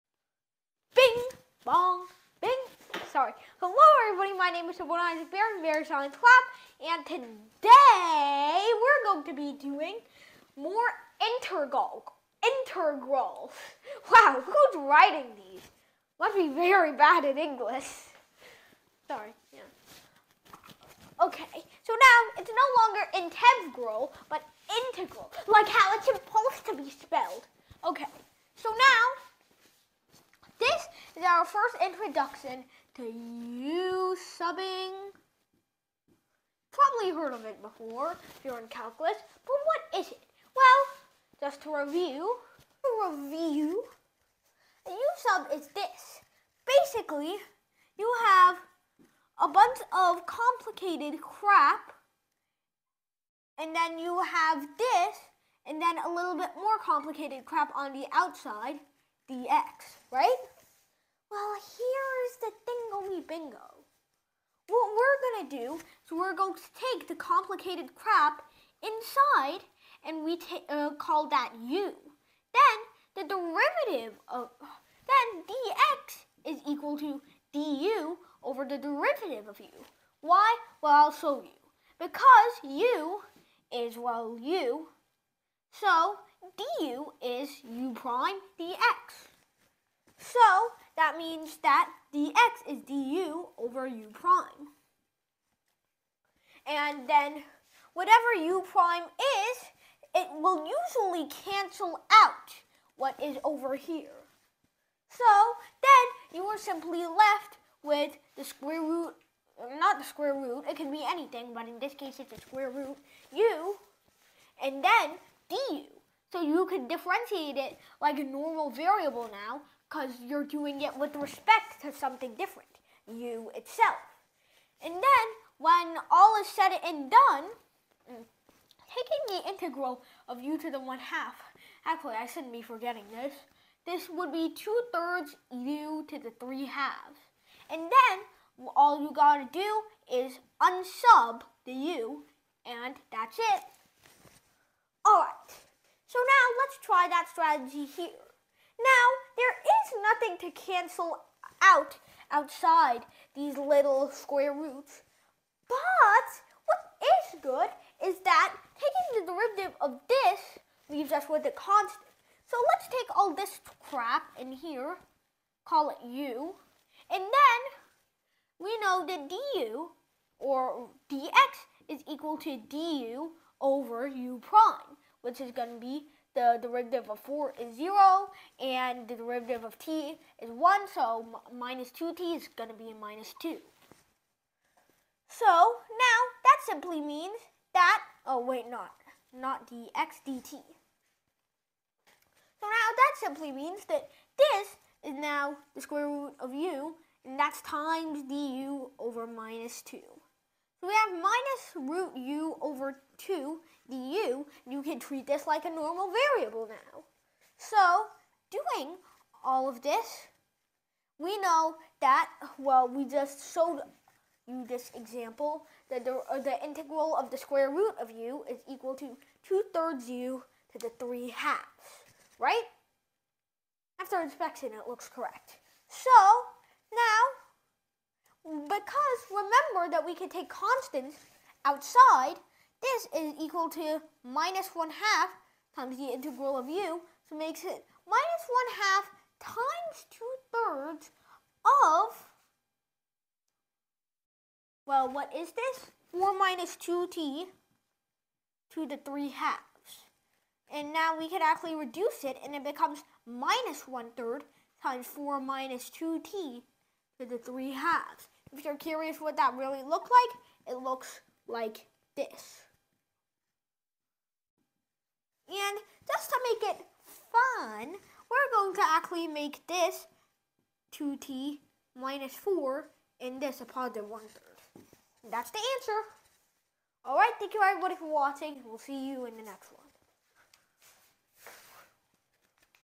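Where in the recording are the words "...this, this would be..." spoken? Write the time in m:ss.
2:13.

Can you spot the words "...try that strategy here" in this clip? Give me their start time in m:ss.
2:26.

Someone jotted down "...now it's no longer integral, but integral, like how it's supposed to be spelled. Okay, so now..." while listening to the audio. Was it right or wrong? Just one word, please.
right.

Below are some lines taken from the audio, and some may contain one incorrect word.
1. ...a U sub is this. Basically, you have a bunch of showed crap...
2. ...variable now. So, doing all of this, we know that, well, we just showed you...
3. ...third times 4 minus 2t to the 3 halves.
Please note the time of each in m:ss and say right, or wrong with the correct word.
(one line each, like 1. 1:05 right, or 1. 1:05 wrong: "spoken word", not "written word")
1. 0:44 wrong: "complicated", not "showed"
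2. 3:26 right
3. 4:14 right.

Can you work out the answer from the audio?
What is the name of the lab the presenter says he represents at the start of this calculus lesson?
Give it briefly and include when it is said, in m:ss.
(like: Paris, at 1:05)
Bari Science Lab, at 0:05.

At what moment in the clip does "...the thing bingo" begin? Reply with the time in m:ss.
1:02.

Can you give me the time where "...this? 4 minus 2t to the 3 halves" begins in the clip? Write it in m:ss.
4:05.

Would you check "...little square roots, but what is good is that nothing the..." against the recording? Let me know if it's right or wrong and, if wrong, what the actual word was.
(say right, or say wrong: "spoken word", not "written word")
wrong: "taking", not "nothing".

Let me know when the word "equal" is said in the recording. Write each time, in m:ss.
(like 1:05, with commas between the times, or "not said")
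1:16, 2:52, 3:38, 3:53.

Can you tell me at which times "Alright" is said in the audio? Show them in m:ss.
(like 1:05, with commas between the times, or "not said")
2:25, 4:37.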